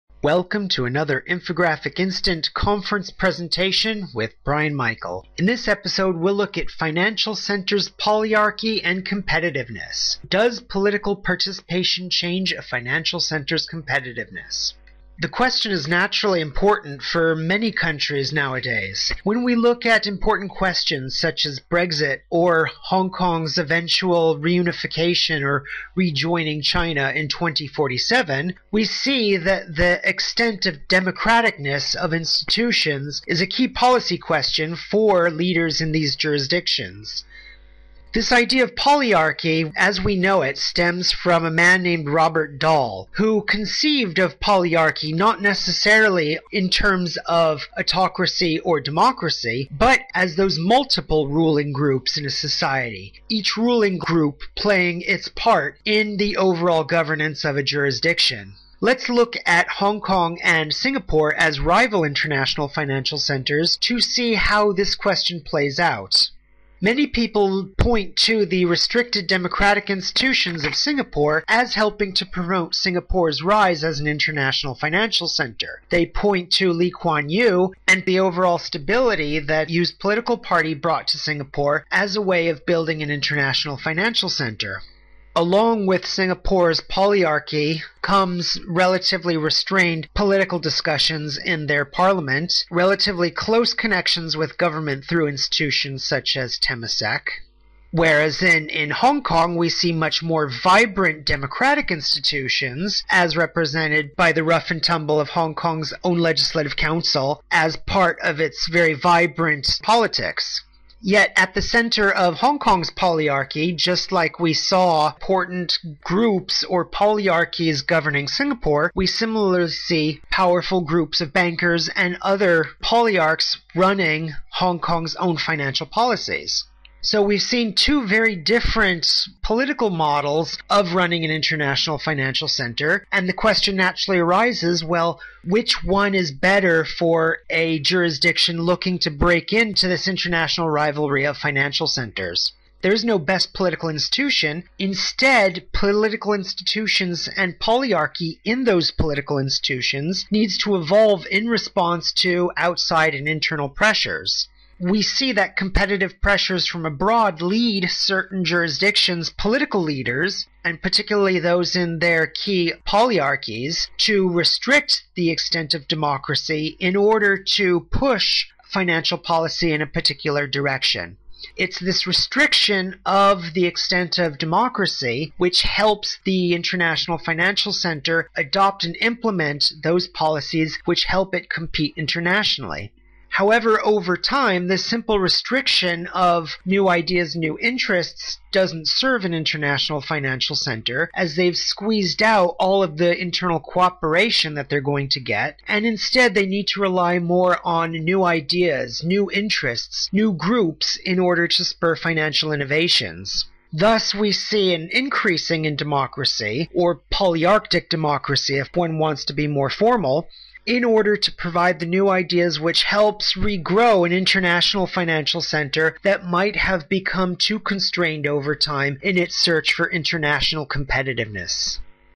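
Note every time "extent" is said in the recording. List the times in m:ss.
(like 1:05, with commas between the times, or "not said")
0:30, 2:45, 2:53.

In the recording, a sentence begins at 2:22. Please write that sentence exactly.
There is no best political institution.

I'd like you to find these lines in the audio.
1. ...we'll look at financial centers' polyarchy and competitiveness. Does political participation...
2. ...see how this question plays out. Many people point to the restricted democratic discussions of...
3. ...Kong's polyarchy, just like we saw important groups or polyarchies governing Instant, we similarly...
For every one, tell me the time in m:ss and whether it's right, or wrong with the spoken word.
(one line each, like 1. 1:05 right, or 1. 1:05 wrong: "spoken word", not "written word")
1. 0:06 right
2. 1:04 wrong: "institutions", not "discussions"
3. 1:52 wrong: "Singapore", not "Instant".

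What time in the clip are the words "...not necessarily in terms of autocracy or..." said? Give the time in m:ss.
0:45.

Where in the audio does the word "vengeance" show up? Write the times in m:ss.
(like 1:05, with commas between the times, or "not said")
not said.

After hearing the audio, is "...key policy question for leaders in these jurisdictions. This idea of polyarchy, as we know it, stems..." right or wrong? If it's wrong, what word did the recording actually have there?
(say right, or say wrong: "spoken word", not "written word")
right.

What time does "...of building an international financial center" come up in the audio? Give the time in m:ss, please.
1:22.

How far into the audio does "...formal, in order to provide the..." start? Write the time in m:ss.
3:29.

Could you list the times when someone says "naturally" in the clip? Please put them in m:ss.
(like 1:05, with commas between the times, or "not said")
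0:15, 2:13.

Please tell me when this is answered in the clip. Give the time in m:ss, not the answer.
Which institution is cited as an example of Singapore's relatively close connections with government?
1:36.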